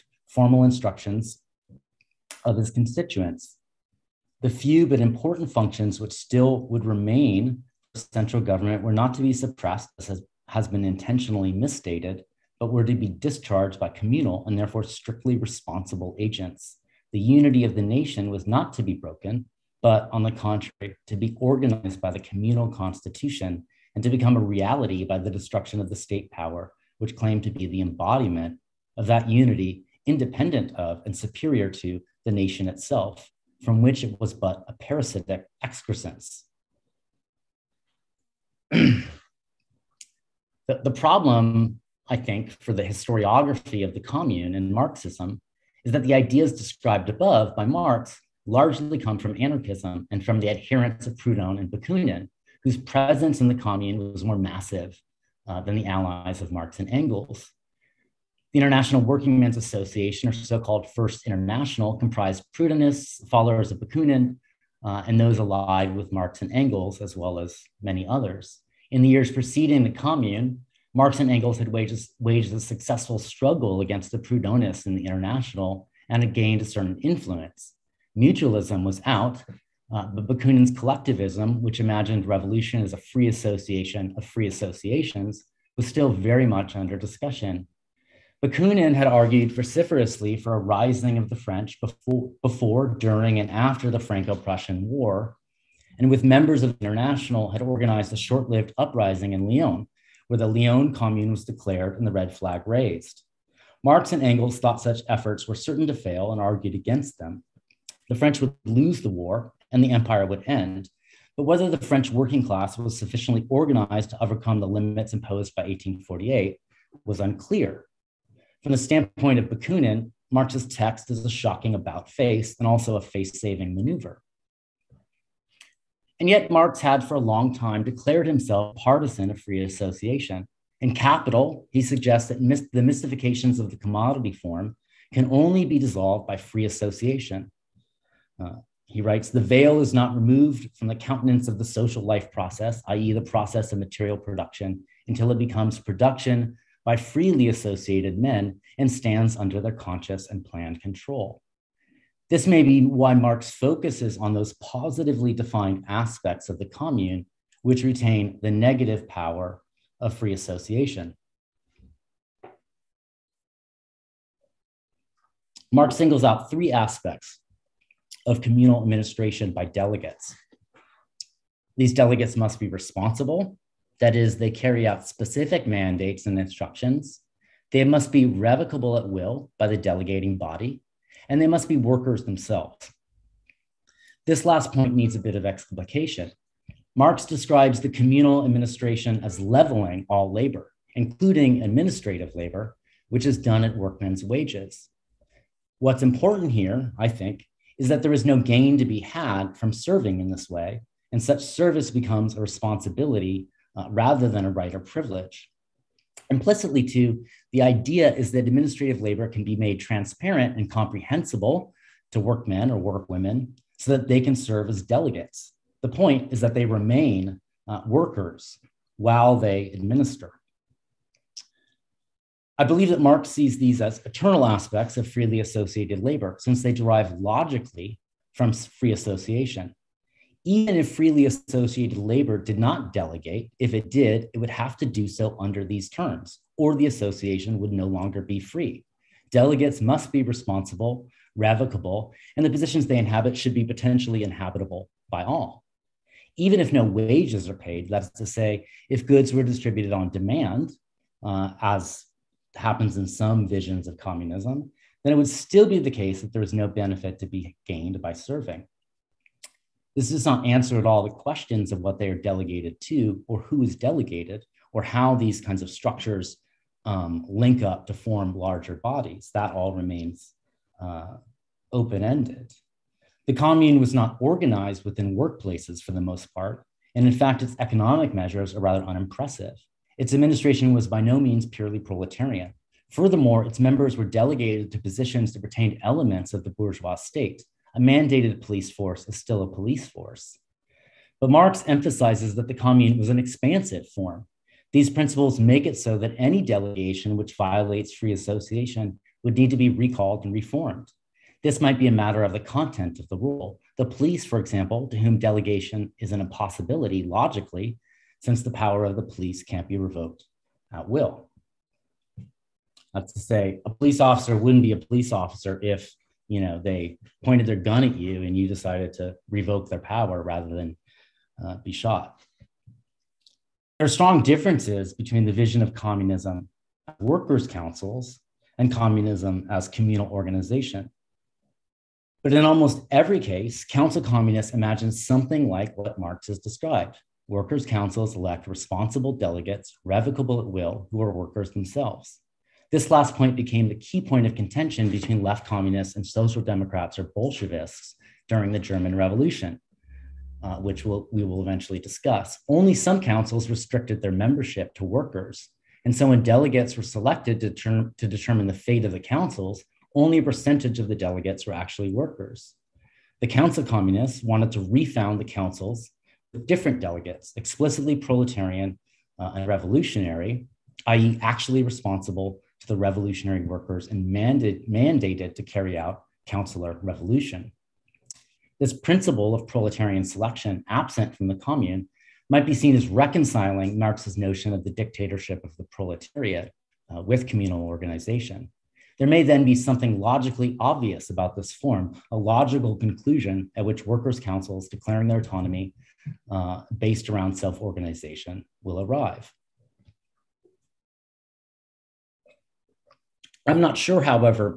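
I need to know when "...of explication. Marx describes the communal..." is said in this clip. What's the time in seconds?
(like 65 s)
185 s.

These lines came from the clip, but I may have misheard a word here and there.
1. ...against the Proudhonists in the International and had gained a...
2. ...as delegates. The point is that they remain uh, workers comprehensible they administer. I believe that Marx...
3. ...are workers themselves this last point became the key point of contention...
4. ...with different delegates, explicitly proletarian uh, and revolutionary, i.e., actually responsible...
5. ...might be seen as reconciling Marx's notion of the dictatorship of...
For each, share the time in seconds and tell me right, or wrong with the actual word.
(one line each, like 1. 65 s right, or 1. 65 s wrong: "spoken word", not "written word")
1. 73 s right
2. 214 s wrong: "while", not "comprehensible"
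3. 341 s right
4. 366 s right
5. 382 s right.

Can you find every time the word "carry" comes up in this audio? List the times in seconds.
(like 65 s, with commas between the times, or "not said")
174 s, 375 s.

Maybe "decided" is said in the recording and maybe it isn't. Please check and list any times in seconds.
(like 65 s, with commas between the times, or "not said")
318 s.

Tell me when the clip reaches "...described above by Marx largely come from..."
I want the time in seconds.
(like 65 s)
46 s.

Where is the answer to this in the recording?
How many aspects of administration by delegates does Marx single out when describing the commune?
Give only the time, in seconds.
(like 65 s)
166 s.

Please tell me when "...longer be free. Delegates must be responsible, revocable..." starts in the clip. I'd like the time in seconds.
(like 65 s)
237 s.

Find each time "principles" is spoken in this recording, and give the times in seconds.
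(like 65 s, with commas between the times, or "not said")
294 s, 378 s.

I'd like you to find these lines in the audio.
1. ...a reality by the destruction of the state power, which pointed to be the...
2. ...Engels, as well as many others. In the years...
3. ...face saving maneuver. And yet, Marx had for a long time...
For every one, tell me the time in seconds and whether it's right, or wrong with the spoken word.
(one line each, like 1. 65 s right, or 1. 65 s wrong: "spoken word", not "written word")
1. 24 s wrong: "claimed", not "pointed"
2. 66 s right
3. 123 s right.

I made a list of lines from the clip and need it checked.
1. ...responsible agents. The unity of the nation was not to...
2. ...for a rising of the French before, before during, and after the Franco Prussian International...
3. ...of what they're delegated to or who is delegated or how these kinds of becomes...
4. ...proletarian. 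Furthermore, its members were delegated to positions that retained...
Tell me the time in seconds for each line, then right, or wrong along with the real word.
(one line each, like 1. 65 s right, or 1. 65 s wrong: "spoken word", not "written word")
1. 15 s right
2. 90 s wrong: "War", not "International"
3. 261 s wrong: "structures", not "becomes"
4. 281 s right.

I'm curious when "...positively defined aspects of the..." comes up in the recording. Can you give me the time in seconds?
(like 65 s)
154 s.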